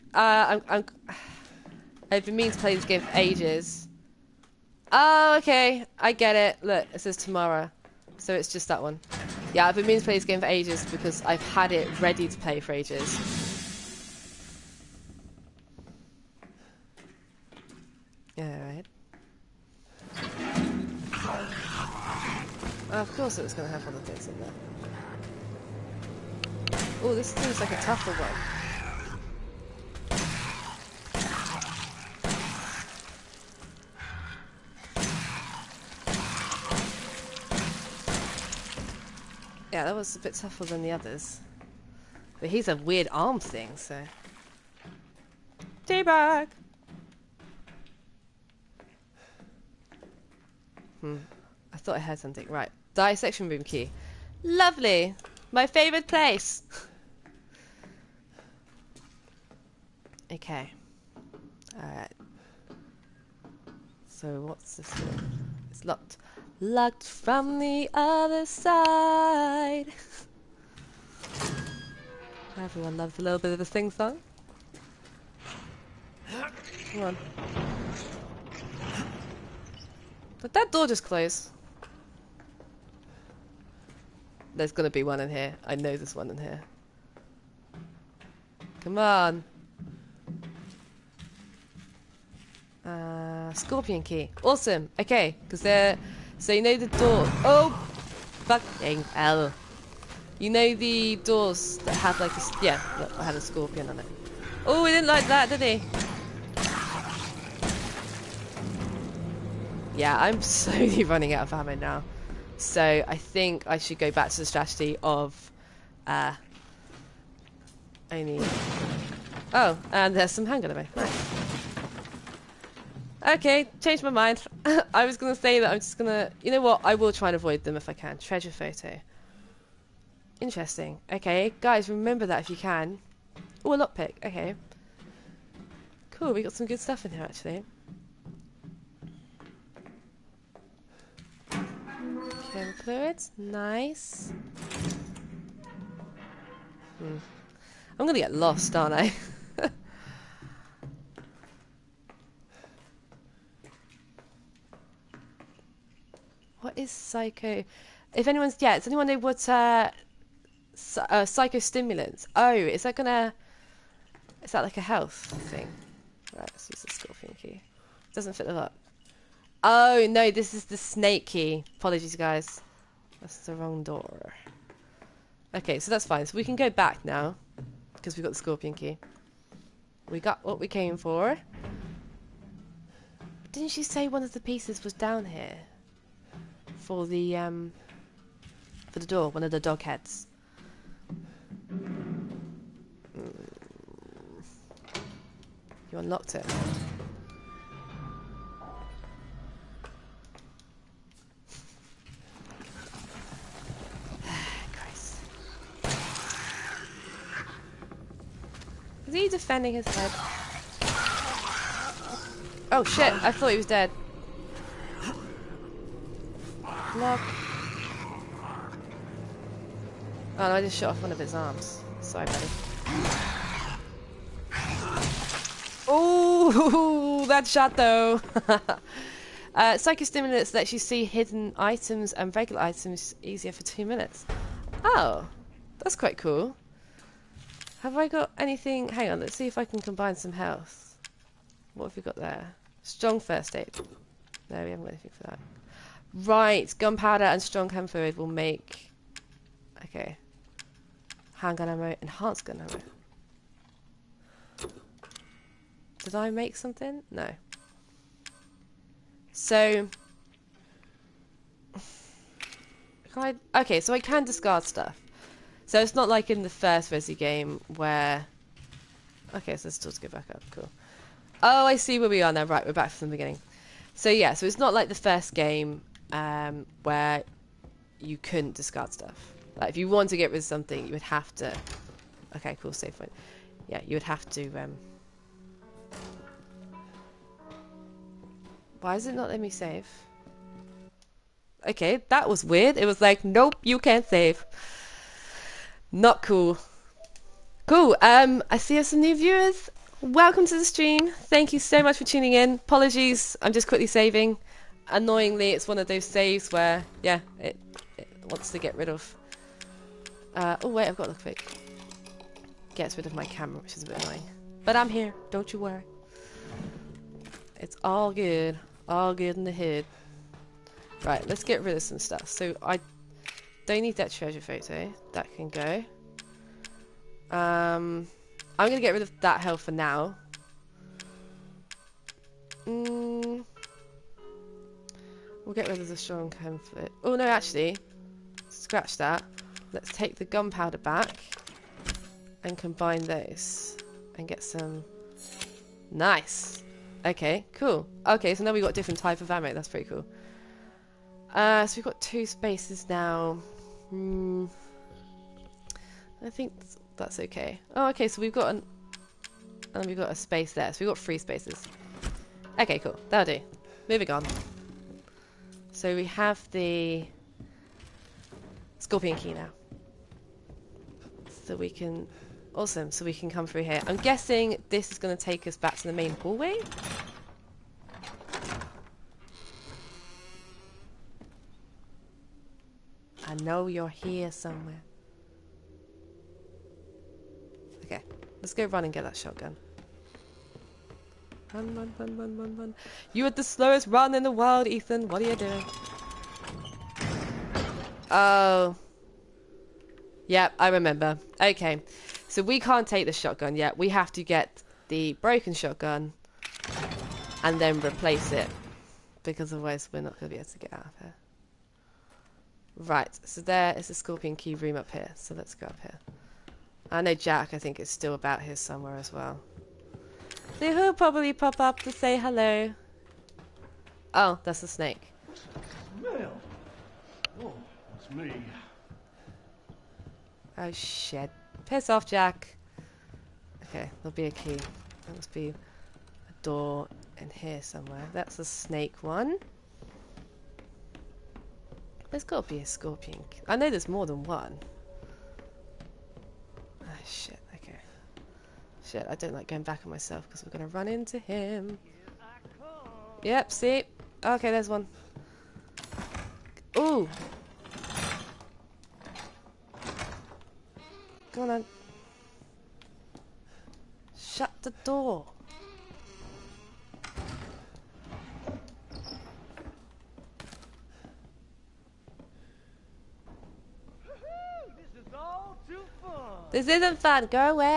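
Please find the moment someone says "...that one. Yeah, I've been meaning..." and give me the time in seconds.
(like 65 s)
8 s.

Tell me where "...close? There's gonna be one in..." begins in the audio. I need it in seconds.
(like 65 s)
81 s.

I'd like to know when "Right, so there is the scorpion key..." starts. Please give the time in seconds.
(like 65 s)
412 s.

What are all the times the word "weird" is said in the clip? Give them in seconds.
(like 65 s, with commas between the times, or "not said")
42 s, 292 s.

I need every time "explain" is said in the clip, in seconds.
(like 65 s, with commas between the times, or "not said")
not said.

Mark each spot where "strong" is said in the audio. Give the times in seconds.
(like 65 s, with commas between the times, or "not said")
242 s, 247 s, 335 s.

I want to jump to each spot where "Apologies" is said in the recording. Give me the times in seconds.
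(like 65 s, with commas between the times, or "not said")
171 s, 302 s.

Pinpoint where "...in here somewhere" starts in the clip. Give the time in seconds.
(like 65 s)
437 s.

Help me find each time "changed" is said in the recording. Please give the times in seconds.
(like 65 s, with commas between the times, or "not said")
123 s.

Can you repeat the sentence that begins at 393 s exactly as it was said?
You are the slowest run in the world, Ethan.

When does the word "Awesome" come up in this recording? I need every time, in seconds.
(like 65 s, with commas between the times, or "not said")
94 s, 372 s.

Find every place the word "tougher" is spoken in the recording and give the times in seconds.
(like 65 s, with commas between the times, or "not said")
27 s, 40 s.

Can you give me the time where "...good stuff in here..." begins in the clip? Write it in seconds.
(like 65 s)
136 s.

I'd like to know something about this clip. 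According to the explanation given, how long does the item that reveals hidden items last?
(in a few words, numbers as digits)
2 minutes.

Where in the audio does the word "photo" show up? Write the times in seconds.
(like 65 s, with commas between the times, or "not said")
128 s, 324 s.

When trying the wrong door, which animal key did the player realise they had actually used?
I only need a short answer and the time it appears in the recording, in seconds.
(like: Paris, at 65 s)
Snake key, at 170 s.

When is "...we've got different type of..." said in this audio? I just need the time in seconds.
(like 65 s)
348 s.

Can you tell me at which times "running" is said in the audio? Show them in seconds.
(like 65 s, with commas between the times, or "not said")
111 s.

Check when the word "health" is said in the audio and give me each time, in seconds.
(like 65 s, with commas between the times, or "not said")
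164 s, 240 s, 329 s.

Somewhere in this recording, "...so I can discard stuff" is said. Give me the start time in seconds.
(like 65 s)
263 s.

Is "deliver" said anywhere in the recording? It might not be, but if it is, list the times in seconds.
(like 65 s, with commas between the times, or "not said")
not said.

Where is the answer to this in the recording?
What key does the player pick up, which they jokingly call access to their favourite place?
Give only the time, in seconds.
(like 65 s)
52 s.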